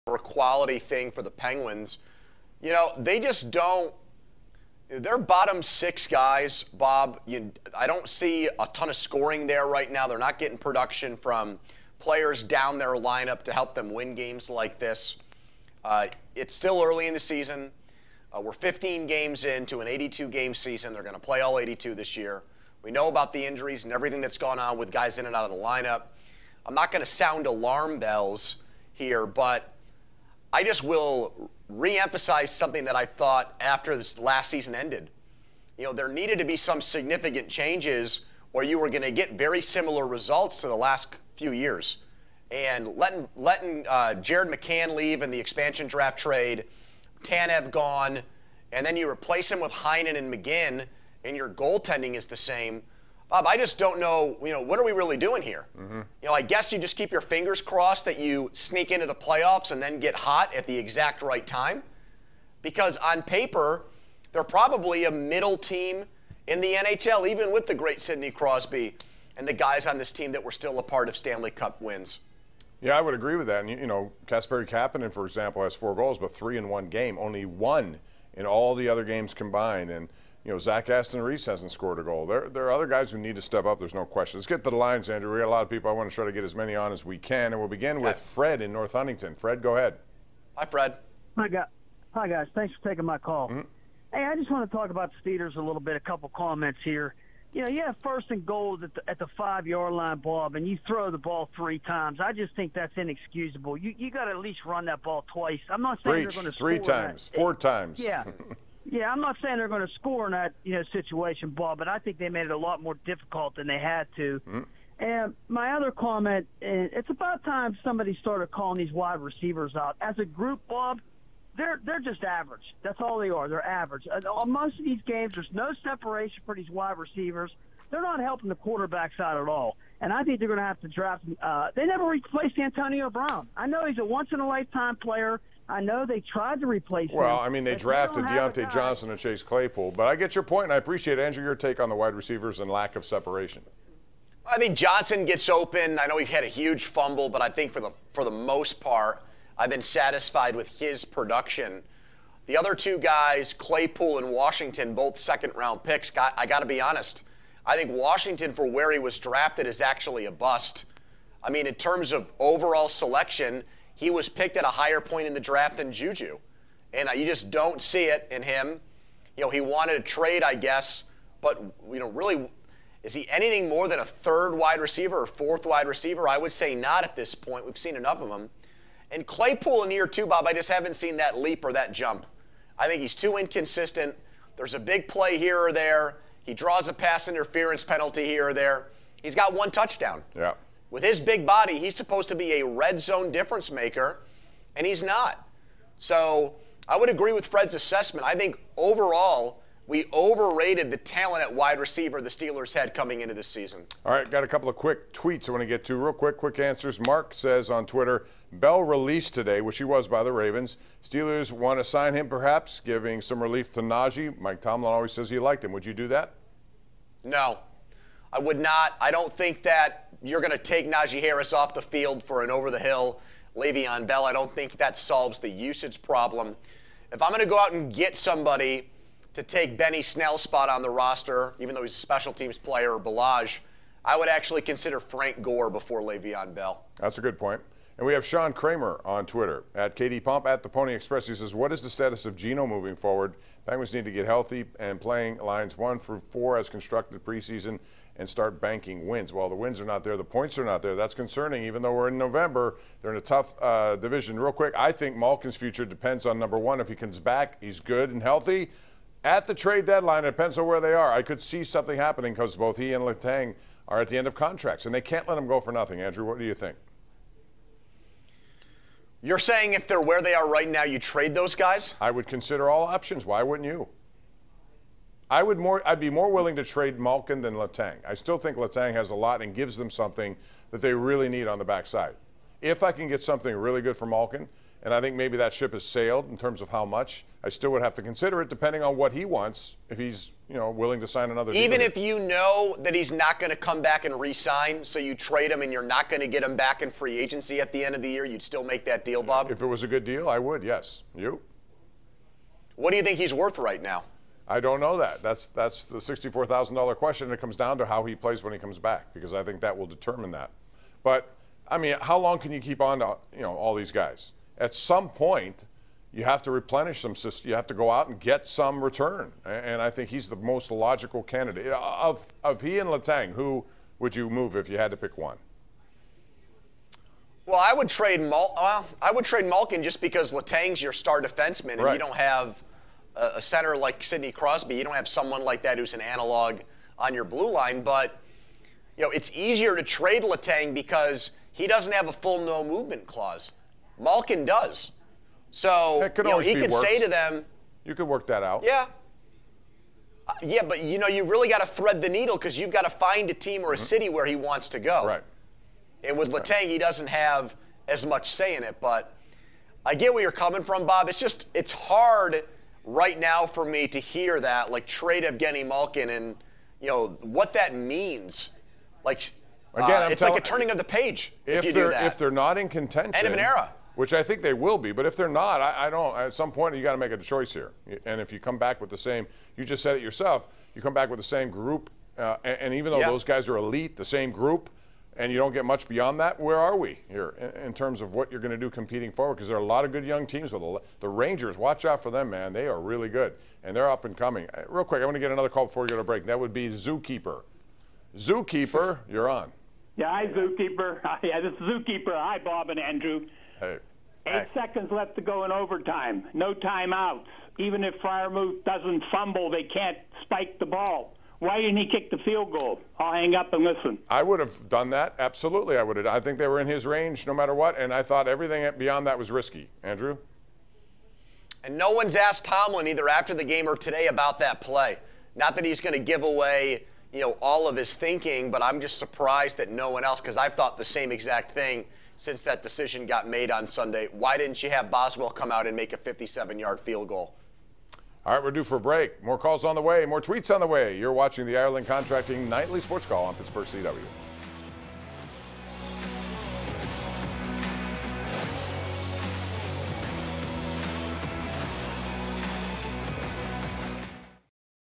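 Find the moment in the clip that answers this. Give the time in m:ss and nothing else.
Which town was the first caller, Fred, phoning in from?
1:28.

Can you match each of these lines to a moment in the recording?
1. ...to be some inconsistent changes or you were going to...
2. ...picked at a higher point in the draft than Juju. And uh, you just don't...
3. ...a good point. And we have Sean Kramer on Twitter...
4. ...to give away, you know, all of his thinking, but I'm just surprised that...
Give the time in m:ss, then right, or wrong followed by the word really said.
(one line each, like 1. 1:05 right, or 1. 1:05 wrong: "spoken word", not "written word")
1. 0:36 wrong: "significant", not "inconsistent"
2. 2:44 right
3. 3:57 right
4. 7:05 right.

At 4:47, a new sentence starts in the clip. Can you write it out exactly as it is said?
I still would have to consider it depending on what he wants if he's, you know, willing to sign another Even deal.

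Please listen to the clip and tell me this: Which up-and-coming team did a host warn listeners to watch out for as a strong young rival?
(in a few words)
Rangers.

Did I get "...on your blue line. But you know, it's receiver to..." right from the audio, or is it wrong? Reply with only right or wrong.
wrong.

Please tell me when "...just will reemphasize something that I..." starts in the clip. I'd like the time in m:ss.
0:30.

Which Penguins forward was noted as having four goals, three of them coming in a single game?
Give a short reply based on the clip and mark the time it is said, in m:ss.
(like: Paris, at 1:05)
Kasperi Kapanen, at 1:14.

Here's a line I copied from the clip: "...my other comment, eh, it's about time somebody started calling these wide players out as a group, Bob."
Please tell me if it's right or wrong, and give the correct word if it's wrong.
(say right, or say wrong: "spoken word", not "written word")
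wrong: "receivers", not "players".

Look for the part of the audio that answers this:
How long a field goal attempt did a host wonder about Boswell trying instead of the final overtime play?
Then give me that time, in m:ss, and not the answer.
7:15.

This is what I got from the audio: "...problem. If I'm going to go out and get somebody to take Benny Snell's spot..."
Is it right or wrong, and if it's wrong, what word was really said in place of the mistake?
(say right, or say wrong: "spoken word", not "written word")
right.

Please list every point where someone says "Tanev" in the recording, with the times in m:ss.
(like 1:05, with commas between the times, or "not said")
0:47.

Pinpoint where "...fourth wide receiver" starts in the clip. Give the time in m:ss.
2:55.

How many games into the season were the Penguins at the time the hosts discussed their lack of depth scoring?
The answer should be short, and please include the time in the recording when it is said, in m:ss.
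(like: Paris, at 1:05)
15, at 0:18.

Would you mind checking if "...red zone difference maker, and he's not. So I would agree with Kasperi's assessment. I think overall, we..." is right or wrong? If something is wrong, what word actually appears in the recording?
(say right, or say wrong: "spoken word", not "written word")
wrong: "Fred", not "Kasperi".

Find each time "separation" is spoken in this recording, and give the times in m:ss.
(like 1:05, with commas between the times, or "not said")
2:05, 2:23.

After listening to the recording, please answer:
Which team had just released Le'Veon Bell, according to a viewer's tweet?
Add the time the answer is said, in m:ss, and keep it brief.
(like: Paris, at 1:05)
Ravens, at 3:30.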